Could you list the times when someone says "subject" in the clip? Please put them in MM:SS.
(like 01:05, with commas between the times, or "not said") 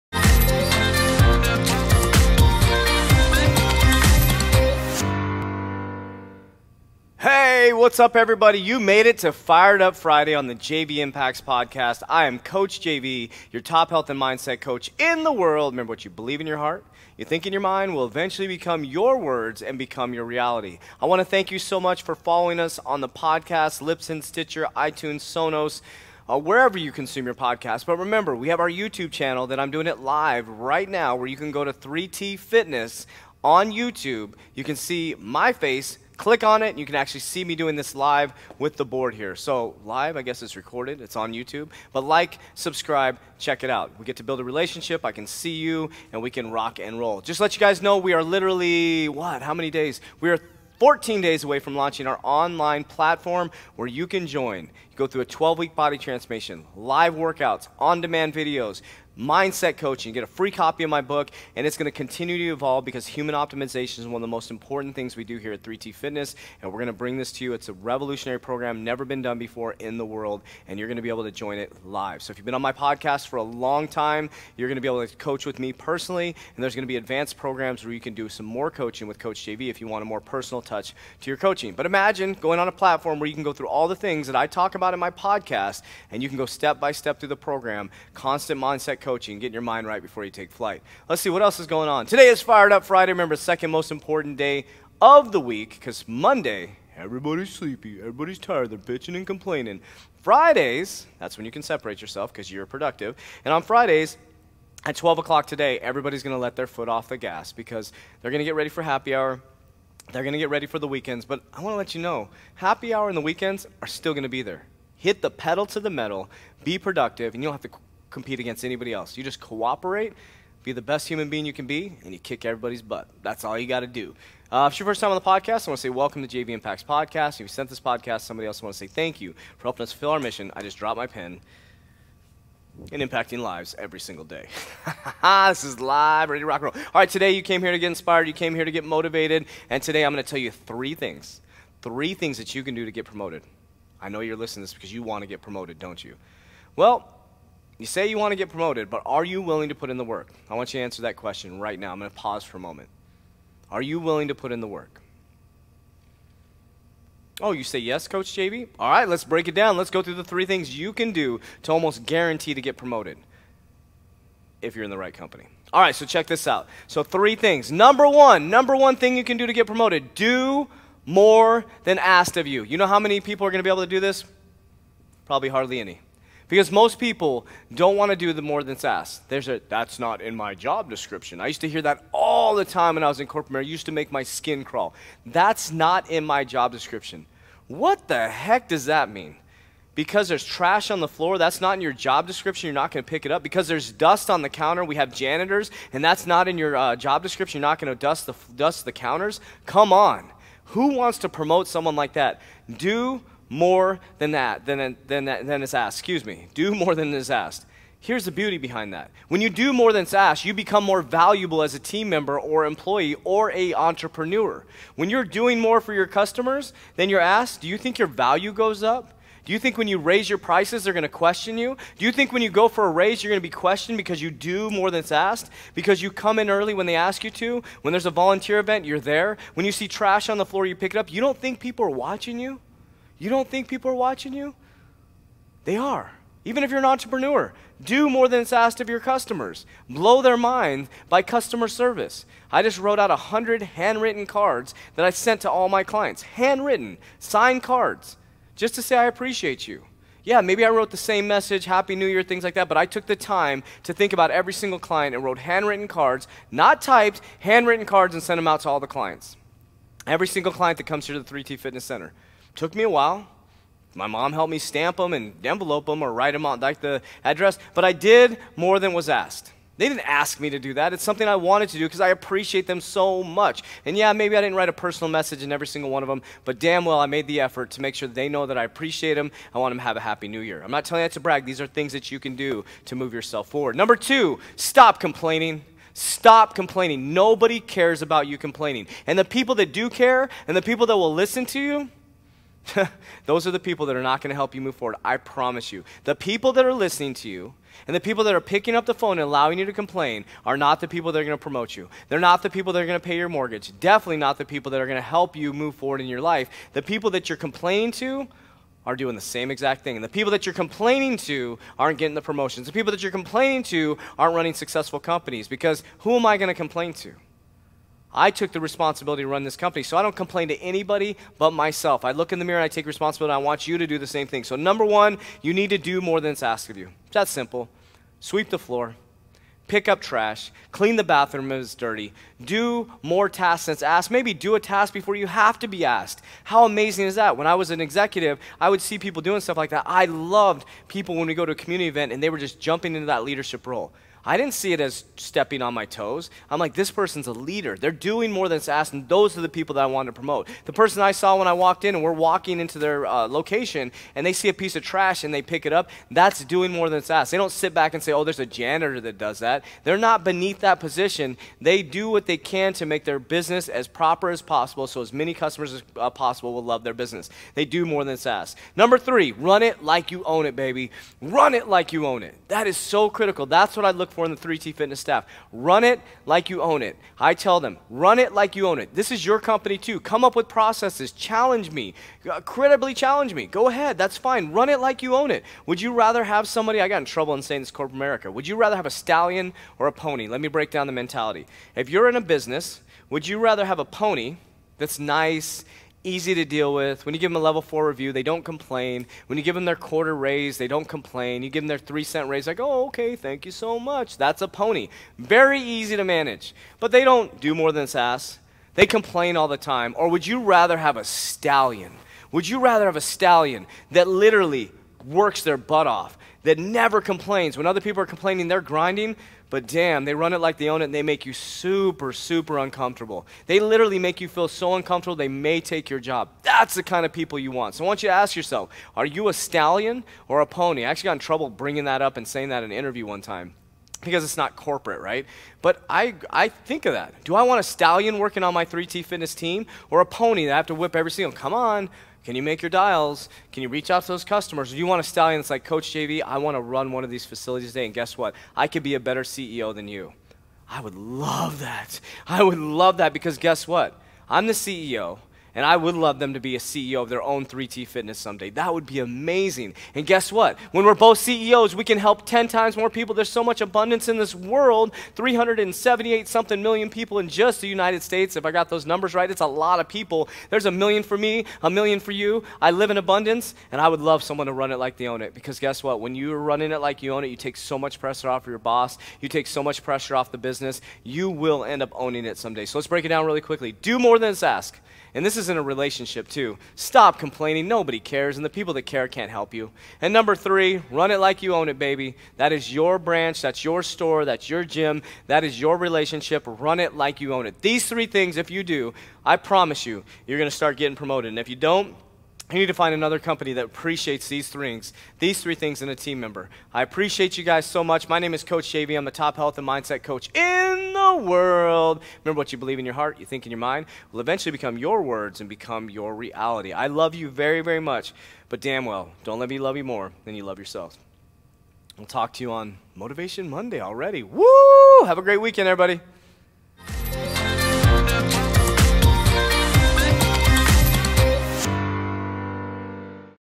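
not said.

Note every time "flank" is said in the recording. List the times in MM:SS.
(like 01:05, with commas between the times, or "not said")
not said.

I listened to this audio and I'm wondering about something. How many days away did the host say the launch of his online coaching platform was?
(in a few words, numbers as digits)
14.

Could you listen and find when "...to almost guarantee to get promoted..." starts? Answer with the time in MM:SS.
02:41.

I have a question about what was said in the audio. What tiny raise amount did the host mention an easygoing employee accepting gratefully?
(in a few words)
3 cents.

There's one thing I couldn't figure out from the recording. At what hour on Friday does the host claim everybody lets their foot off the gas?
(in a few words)
12 o'clock.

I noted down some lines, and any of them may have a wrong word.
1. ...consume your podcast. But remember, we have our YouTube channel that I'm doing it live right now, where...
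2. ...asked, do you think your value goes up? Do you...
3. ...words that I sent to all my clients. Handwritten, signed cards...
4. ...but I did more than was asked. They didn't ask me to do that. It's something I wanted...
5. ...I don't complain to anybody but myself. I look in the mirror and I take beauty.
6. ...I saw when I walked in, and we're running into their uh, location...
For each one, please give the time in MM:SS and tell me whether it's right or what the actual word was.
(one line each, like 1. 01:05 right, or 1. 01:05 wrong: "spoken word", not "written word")
1. 00:26 right
2. 03:37 right
3. 04:04 wrong: "cards", not "words"
4. 04:27 right
5. 05:19 wrong: "responsibility", not "beauty"
6. 05:51 wrong: "walking", not "running".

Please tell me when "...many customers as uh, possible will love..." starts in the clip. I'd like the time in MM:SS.
06:05.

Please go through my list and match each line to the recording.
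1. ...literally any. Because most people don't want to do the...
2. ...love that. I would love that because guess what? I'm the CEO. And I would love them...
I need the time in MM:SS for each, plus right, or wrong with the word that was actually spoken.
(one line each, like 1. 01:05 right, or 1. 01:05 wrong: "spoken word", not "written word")
1. 02:55 wrong: "hardly", not "literally"
2. 07:30 right.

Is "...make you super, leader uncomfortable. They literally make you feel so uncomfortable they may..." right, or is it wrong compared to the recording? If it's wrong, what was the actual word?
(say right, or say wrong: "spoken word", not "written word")
wrong: "super", not "leader".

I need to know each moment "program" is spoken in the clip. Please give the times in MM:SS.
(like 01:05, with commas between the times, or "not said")
01:08, 01:17, 01:27.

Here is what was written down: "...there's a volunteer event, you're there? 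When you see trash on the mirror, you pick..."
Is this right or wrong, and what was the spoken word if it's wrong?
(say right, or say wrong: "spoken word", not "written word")
wrong: "floor", not "mirror".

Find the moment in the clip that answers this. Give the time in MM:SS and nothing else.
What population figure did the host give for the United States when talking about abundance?
07:45.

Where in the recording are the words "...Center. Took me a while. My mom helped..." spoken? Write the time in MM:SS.
04:21.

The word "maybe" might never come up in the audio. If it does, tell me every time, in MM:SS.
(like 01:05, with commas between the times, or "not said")
04:10, 04:34, 05:34.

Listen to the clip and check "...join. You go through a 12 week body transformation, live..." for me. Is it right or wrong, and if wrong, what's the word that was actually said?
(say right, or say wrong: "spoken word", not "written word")
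right.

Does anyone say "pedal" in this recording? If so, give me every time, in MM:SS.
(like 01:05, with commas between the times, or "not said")
01:55.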